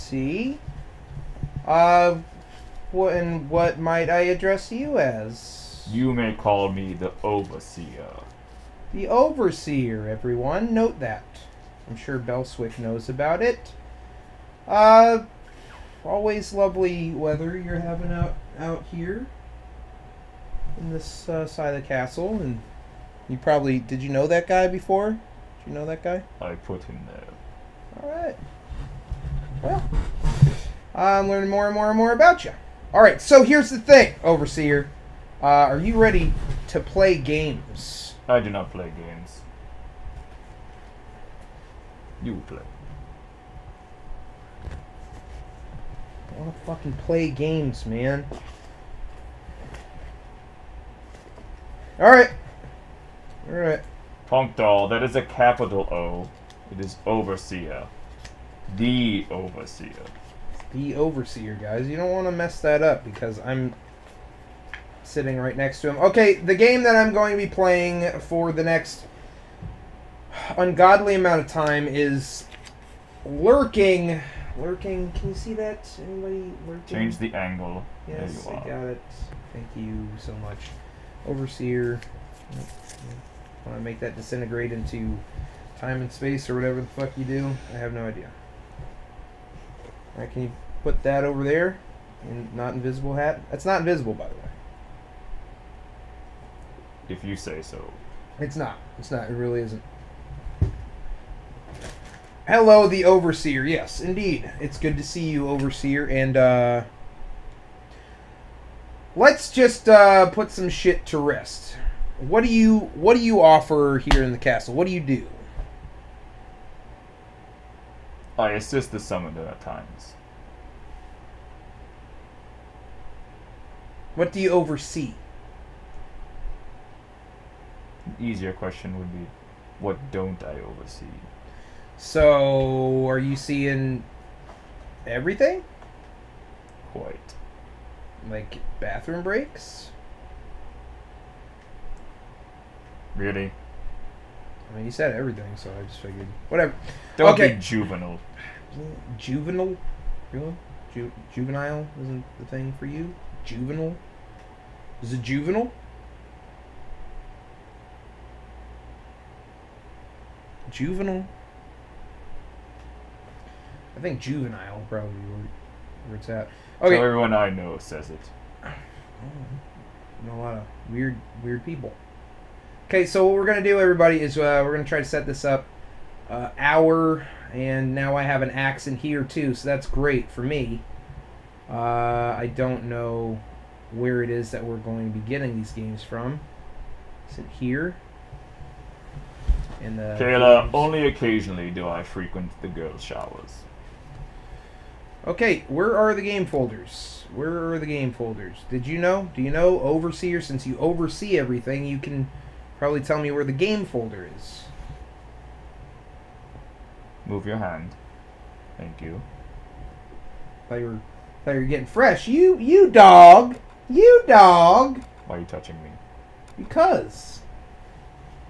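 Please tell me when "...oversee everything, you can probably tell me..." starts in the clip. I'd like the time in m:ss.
3:20.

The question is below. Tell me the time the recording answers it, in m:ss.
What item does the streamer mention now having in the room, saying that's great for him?
2:58.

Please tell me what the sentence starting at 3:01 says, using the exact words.
Uh, I don't know where it is that we're going to be getting these games from.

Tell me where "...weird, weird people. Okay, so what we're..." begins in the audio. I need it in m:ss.
2:50.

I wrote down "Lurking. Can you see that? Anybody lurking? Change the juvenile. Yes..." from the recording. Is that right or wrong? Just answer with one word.
wrong.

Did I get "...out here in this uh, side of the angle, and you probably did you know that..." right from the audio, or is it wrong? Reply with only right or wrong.
wrong.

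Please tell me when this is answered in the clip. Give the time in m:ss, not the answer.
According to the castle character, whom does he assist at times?
1:58.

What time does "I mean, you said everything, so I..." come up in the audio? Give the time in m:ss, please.
2:24.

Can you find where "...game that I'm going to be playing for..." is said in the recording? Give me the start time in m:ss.
1:06.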